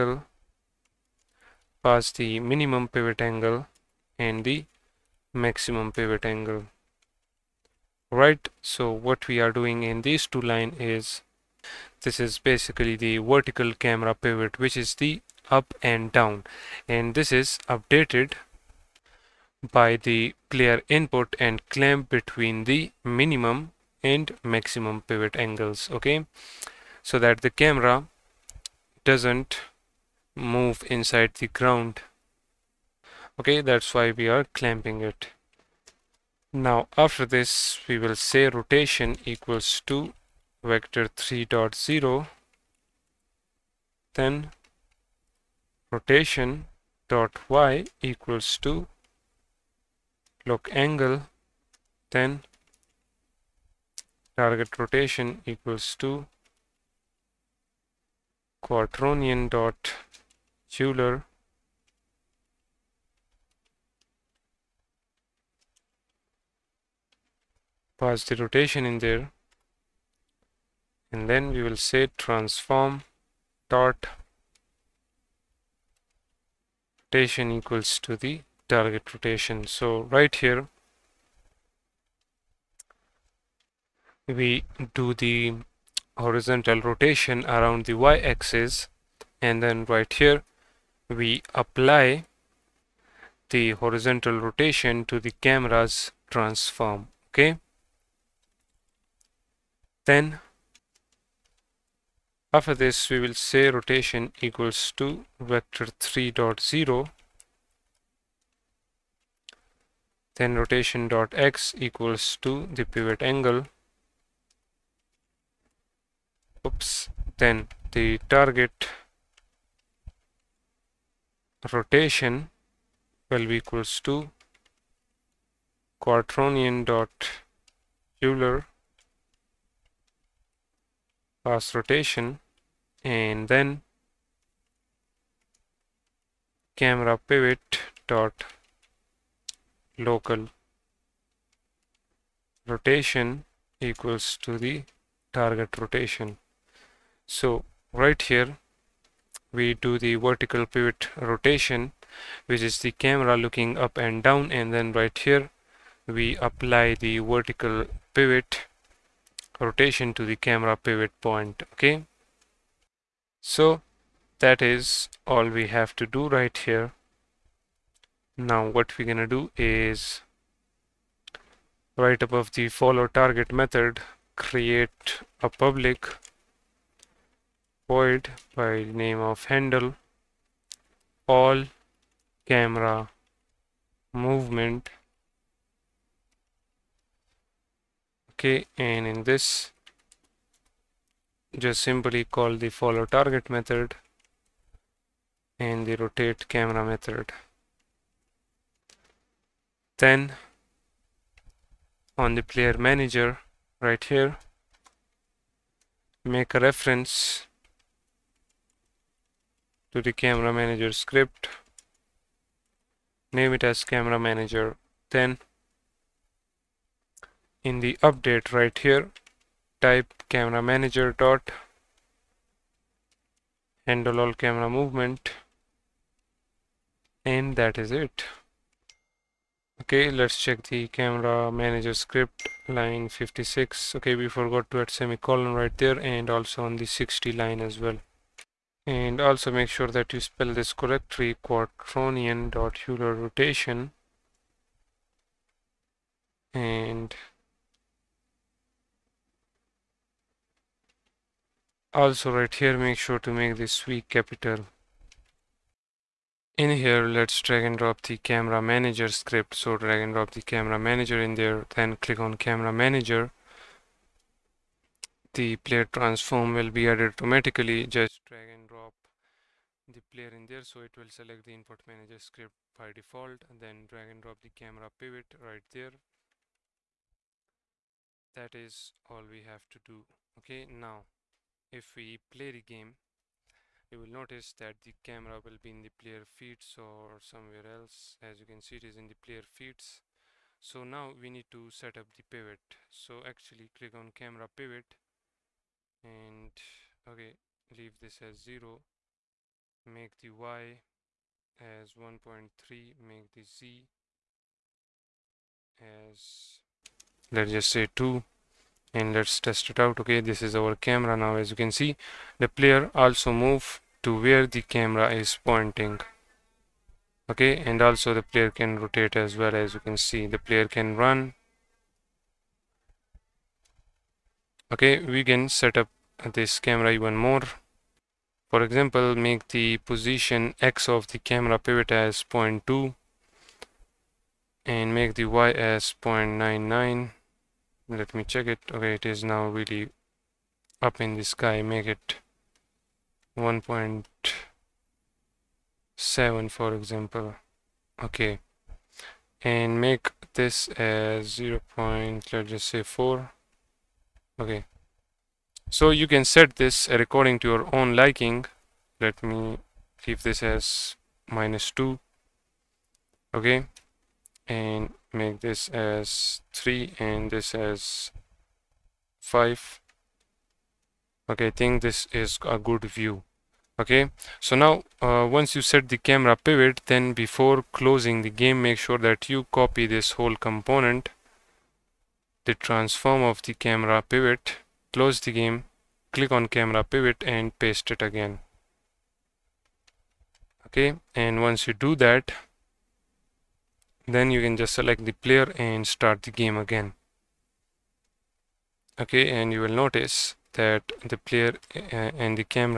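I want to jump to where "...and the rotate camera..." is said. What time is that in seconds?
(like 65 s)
195 s.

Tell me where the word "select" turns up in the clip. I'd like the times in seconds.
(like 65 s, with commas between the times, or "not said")
271 s, 394 s.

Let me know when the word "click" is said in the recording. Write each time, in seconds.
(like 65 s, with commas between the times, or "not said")
261 s, 293 s, 386 s.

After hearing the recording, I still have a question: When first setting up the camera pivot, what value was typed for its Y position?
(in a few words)
1.3.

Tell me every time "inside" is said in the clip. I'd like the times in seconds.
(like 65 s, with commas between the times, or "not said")
30 s.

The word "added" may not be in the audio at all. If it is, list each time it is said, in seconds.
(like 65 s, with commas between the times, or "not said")
266 s.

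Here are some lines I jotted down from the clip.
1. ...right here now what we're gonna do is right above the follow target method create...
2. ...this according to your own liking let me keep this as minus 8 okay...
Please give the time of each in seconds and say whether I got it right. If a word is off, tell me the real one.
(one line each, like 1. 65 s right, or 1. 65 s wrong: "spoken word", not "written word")
1. 166 s right
2. 356 s wrong: "2", not "8".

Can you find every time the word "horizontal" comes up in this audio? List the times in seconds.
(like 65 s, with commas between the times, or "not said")
86 s, 93 s.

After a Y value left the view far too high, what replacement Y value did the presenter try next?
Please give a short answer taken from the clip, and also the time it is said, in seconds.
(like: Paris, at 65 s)
1.7, at 343 s.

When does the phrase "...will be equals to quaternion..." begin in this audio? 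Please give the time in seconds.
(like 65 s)
123 s.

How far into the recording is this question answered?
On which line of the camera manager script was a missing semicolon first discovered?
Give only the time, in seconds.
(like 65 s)
233 s.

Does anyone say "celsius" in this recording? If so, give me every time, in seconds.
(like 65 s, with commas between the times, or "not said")
not said.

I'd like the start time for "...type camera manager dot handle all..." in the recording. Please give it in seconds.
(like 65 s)
219 s.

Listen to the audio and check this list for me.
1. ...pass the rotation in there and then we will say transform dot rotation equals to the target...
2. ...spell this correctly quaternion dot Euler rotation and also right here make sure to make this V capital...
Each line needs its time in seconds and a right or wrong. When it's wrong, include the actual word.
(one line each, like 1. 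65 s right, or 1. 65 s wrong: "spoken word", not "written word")
1. 67 s right
2. 240 s right.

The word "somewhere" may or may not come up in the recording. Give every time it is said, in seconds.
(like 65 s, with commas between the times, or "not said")
287 s.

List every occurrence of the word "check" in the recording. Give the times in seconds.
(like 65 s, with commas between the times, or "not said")
230 s, 338 s.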